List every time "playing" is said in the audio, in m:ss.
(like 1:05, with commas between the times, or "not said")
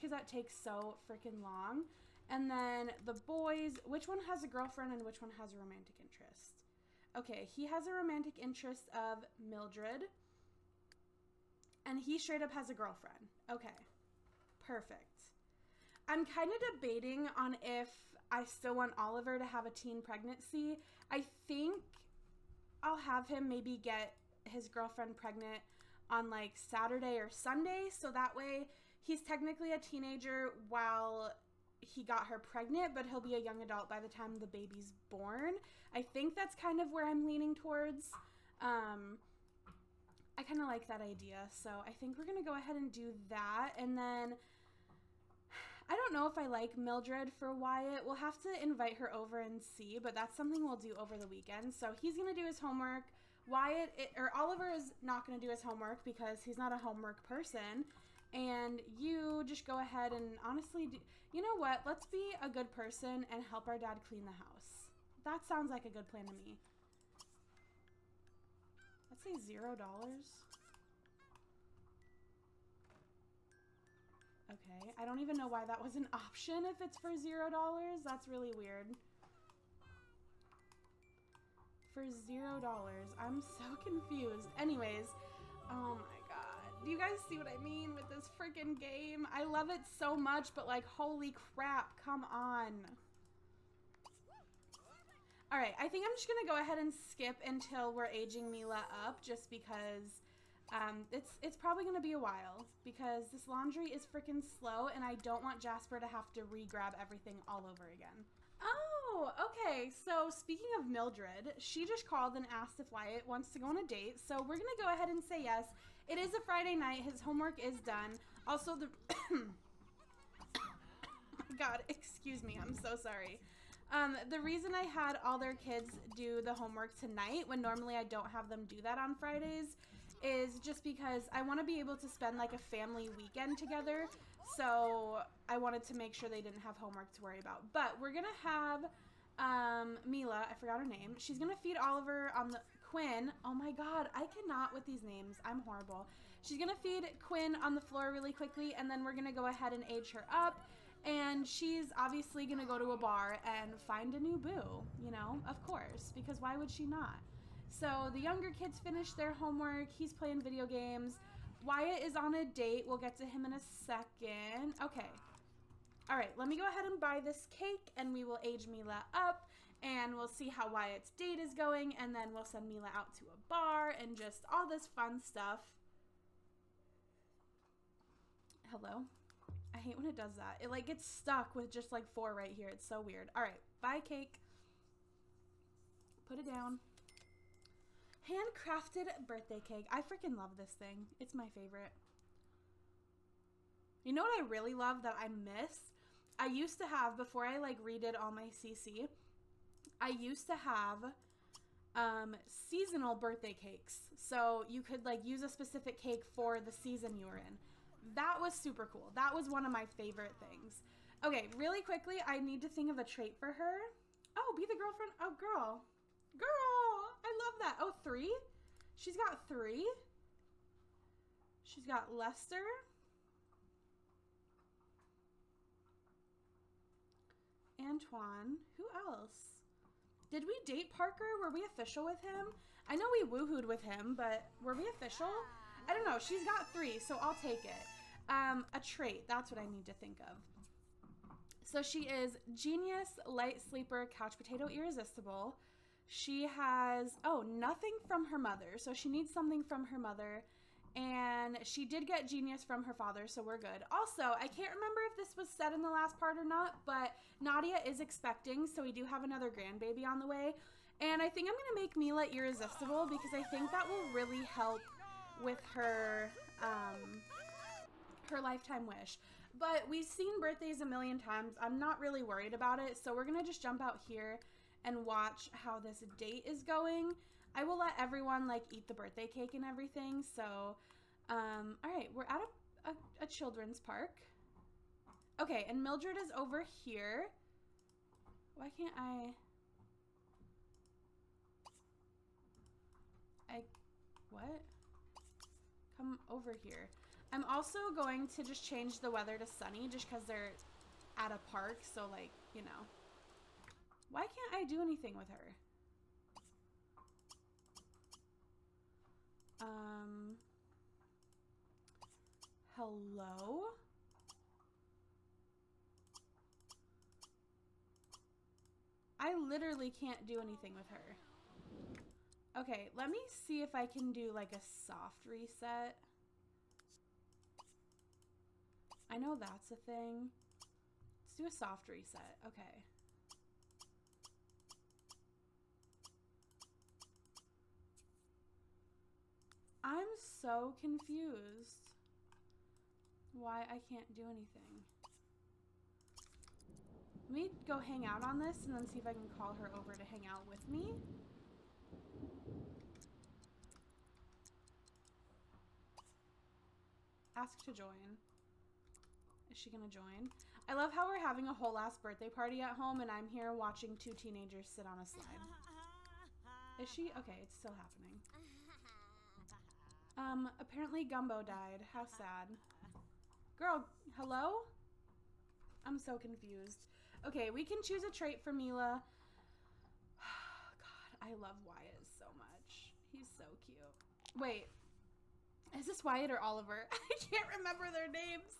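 2:40.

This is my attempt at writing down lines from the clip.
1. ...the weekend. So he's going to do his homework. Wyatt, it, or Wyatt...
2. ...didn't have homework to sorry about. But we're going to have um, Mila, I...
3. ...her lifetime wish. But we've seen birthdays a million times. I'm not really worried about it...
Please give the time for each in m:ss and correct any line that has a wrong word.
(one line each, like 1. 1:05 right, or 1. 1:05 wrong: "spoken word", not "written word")
1. 0:51 wrong: "Oliver", not "Wyatt"
2. 2:16 wrong: "worry", not "sorry"
3. 4:28 right.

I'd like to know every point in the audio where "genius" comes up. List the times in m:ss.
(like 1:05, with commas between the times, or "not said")
4:02, 4:12.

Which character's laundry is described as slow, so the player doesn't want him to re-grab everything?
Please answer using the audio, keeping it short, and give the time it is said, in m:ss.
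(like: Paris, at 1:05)
Jasper, at 1:45.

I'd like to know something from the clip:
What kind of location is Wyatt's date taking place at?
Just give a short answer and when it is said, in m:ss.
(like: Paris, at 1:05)
A children's park, at 4:43.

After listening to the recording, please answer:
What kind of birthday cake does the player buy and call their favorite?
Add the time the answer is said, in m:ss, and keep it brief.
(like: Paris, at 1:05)
Handcrafted birthday cake, at 3:08.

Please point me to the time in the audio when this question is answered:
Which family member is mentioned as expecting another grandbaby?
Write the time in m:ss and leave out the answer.
4:17.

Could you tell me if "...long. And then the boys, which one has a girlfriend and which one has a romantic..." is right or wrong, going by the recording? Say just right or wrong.
right.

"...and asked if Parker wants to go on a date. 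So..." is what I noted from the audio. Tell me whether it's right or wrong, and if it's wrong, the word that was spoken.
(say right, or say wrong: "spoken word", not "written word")
wrong: "Wyatt", not "Parker".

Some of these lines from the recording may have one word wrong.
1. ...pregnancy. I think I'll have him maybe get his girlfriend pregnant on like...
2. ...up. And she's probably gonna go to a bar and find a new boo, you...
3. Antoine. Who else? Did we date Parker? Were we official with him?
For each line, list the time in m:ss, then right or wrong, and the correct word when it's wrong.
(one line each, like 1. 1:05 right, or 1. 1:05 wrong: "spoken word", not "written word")
1. 0:20 right
2. 2:30 wrong: "obviously", not "probably"
3. 3:47 right.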